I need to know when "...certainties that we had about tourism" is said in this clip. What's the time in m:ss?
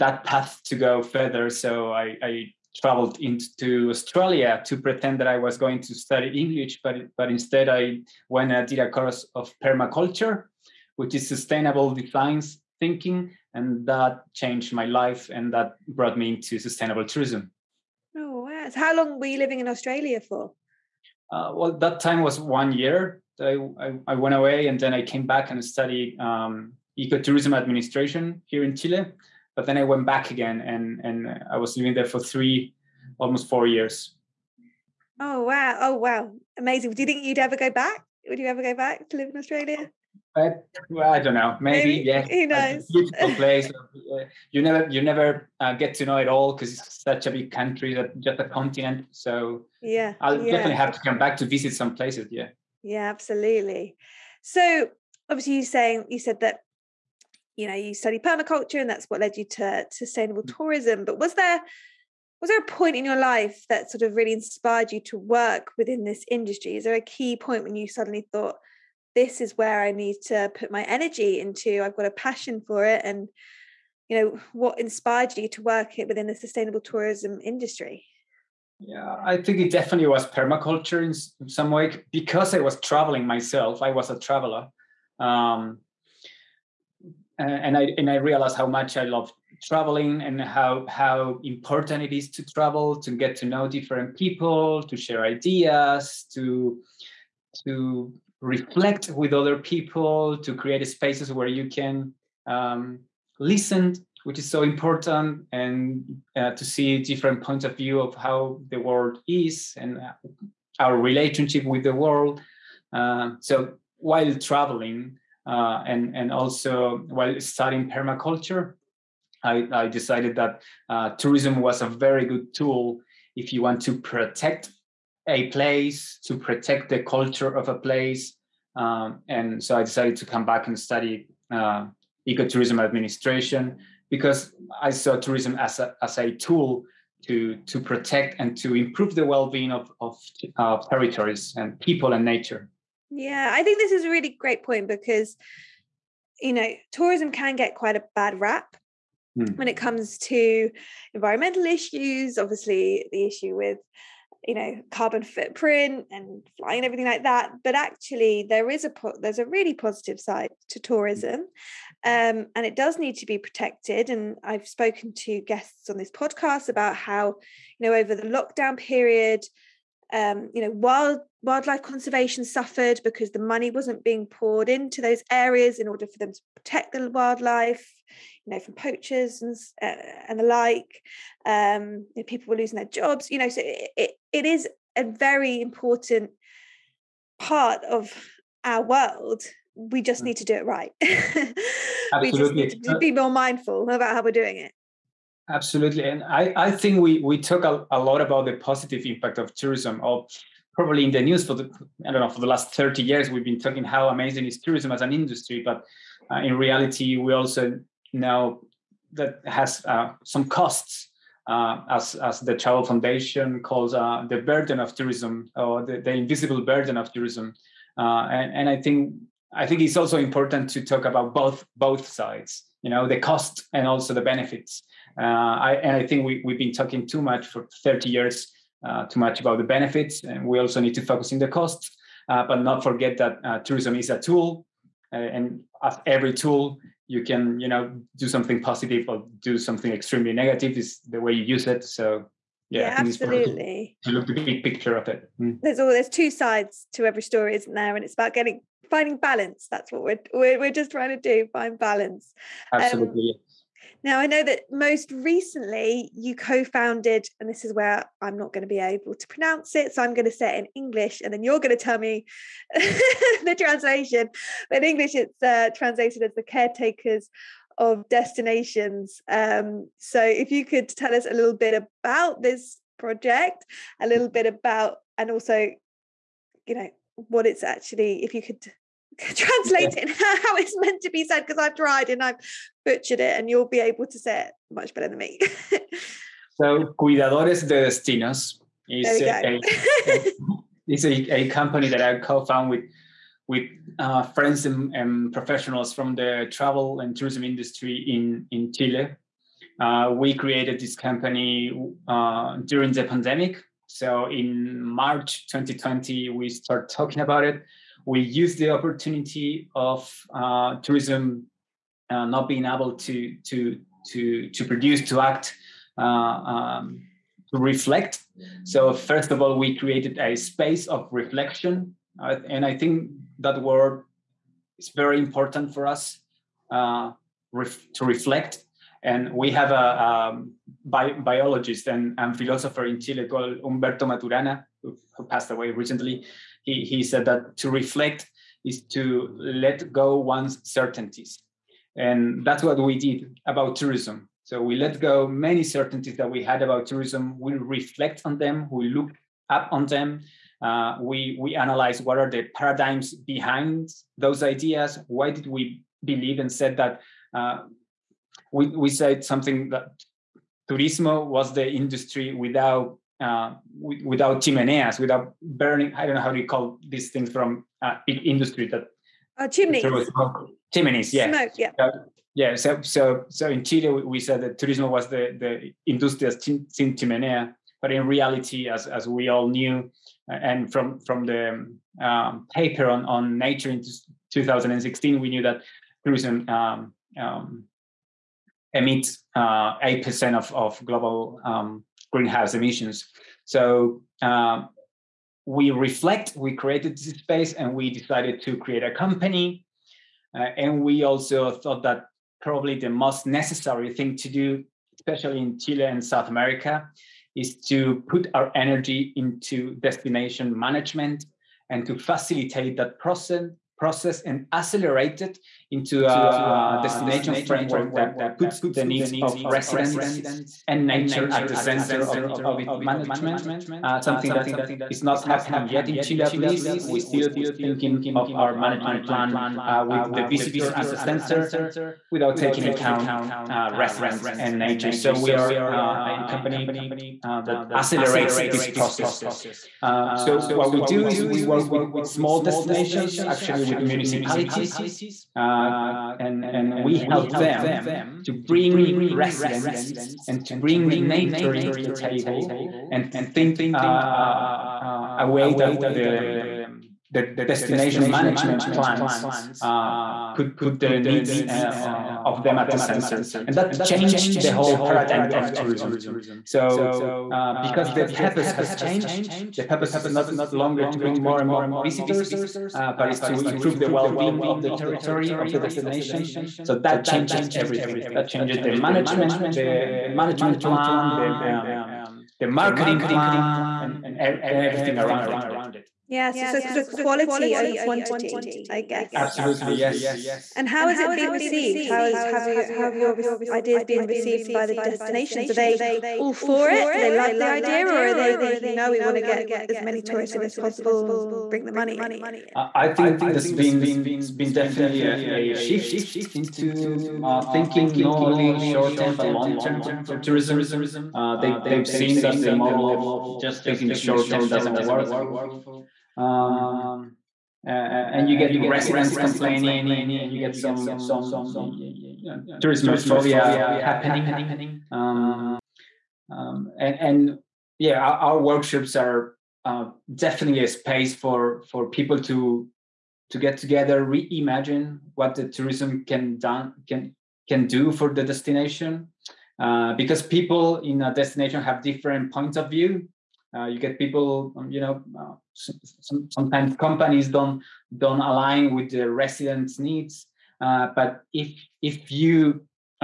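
5:45.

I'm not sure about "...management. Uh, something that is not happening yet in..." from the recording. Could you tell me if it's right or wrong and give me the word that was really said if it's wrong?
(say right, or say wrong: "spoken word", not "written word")
right.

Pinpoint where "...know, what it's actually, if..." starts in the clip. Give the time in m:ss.
4:36.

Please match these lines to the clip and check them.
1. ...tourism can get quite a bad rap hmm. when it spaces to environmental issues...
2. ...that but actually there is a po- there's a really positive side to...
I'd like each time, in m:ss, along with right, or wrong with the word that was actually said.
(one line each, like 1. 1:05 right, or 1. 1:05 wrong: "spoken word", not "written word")
1. 2:26 wrong: "comes", not "spaces"
2. 2:37 right.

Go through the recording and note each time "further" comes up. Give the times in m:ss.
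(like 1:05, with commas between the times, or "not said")
0:01.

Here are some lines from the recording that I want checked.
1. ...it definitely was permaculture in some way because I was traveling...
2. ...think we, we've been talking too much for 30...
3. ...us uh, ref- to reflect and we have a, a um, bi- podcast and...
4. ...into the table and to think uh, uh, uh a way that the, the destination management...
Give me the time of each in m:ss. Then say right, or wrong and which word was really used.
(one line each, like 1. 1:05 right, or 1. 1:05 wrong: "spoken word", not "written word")
1. 1:19 right
2. 3:46 right
3. 5:25 wrong: "biologist", not "podcast"
4. 7:31 right.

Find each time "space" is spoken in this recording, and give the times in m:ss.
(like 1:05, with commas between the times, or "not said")
1:40, 5:20, 6:37, 8:50.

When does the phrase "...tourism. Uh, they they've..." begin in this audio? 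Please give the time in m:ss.
8:30.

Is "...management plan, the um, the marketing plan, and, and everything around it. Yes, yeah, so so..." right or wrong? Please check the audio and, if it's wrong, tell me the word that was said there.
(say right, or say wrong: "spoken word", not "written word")
right.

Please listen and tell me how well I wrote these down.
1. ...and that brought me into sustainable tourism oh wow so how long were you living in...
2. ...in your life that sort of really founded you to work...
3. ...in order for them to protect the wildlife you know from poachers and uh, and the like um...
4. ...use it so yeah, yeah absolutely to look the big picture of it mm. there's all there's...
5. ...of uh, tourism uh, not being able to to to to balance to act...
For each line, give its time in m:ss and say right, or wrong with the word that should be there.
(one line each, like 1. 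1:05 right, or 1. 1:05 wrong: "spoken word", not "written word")
1. 0:15 right
2. 1:02 wrong: "inspired", not "founded"
3. 2:55 right
4. 4:01 right
5. 5:09 wrong: "produce", not "balance".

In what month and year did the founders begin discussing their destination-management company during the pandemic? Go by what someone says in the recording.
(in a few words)
March 2020.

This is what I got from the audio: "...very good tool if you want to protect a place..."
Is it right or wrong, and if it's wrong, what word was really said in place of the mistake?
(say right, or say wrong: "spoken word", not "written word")
right.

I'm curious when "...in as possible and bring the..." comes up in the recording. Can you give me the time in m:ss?
8:20.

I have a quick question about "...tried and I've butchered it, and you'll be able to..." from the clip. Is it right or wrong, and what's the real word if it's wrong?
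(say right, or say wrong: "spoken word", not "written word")
right.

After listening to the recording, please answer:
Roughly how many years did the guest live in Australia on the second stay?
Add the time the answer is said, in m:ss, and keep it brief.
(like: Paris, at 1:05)
Almost 4 years, at 0:32.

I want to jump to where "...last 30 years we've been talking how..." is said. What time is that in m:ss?
3:22.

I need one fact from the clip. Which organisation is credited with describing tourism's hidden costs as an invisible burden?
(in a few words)
The Travel Foundation.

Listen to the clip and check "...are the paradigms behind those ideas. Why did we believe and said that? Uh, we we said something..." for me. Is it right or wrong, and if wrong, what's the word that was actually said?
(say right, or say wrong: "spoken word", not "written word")
right.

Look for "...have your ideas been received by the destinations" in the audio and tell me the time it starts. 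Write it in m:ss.
8:12.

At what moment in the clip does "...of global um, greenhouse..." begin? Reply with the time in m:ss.
6:30.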